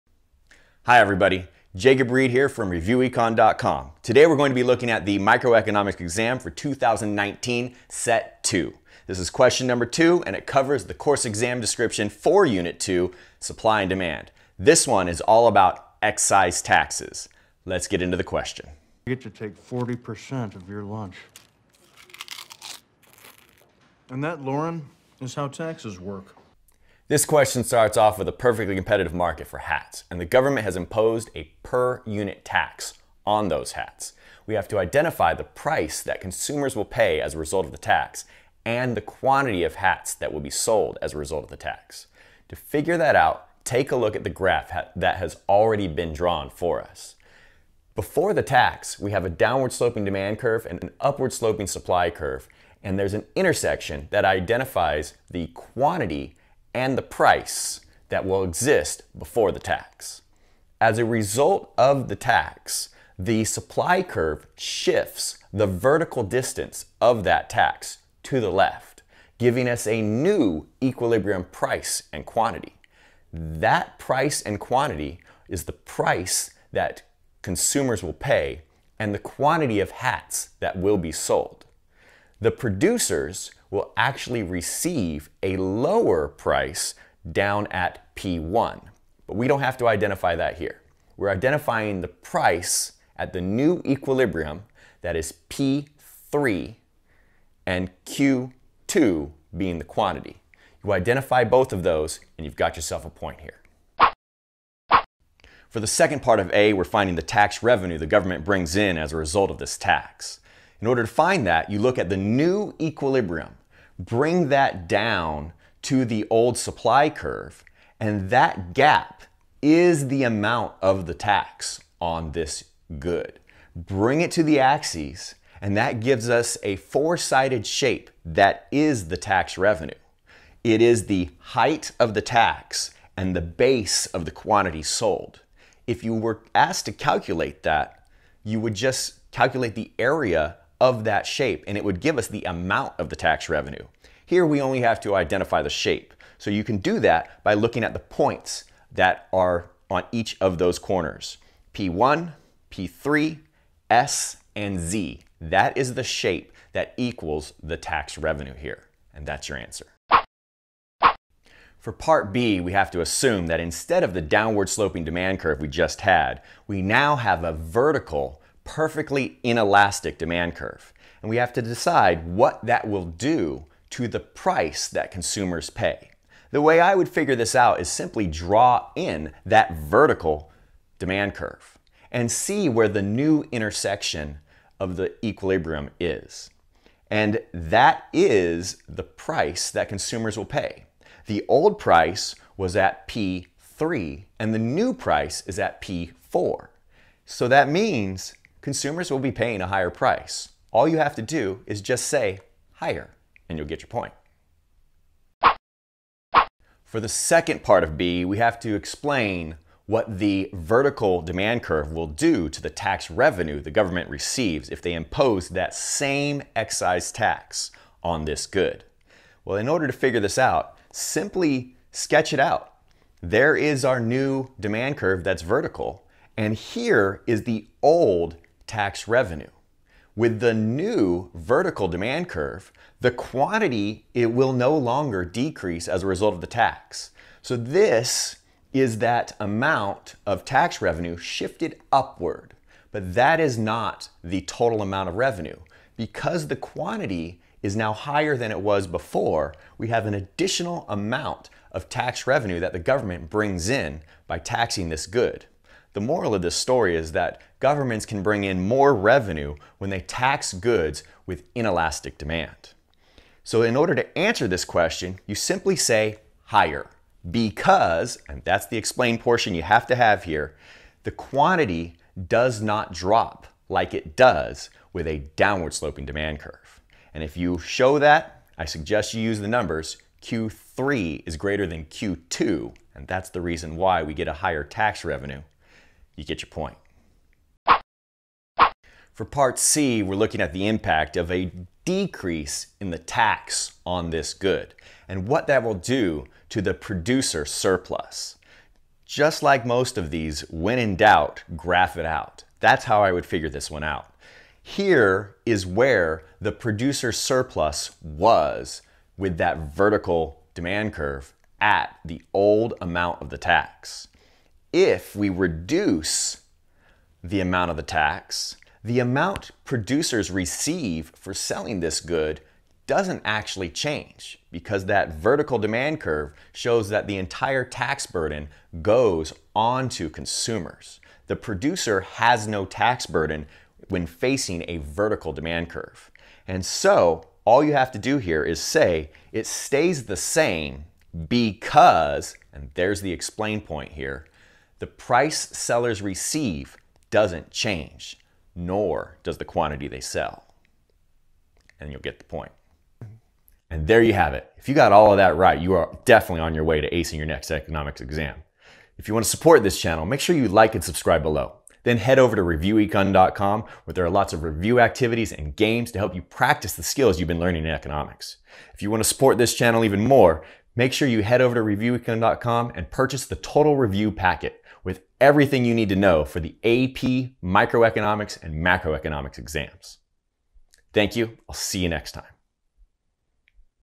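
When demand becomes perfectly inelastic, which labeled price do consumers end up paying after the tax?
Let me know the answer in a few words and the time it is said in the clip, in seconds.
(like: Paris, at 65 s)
P4, at 195 s.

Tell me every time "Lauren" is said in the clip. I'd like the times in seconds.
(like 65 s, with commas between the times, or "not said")
24 s.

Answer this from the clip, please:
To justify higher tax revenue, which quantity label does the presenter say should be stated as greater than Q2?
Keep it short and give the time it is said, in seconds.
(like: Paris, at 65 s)
Q3, at 280 s.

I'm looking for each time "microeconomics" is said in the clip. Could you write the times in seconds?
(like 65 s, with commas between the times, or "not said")
5 s, 377 s.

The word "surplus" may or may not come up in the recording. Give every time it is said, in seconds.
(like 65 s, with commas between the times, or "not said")
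297 s, 307 s.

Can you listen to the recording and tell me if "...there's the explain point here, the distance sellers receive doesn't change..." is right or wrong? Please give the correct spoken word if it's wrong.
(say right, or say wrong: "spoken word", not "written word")
wrong: "price", not "distance".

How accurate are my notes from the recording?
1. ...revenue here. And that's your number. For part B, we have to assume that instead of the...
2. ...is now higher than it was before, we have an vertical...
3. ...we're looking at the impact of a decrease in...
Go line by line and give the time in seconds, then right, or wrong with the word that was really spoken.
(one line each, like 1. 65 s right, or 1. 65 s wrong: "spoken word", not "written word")
1. 158 s wrong: "answer", not "number"
2. 247 s wrong: "additional", not "vertical"
3. 290 s right.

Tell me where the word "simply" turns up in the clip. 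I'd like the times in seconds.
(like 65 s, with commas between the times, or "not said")
177 s, 220 s, 265 s.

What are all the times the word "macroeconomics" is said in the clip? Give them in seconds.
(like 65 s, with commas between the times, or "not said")
378 s.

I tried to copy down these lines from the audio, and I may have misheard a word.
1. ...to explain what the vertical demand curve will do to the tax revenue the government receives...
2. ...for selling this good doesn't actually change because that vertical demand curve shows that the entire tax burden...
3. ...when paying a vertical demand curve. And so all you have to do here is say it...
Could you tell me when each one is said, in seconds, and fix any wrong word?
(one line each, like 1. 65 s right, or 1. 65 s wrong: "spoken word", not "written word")
1. 208 s right
2. 321 s right
3. 333 s wrong: "facing", not "paying".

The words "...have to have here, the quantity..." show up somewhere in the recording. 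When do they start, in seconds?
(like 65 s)
269 s.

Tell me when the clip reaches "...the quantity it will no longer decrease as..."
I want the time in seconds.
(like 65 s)
233 s.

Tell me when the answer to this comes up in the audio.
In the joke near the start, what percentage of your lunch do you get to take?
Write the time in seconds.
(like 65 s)
19 s.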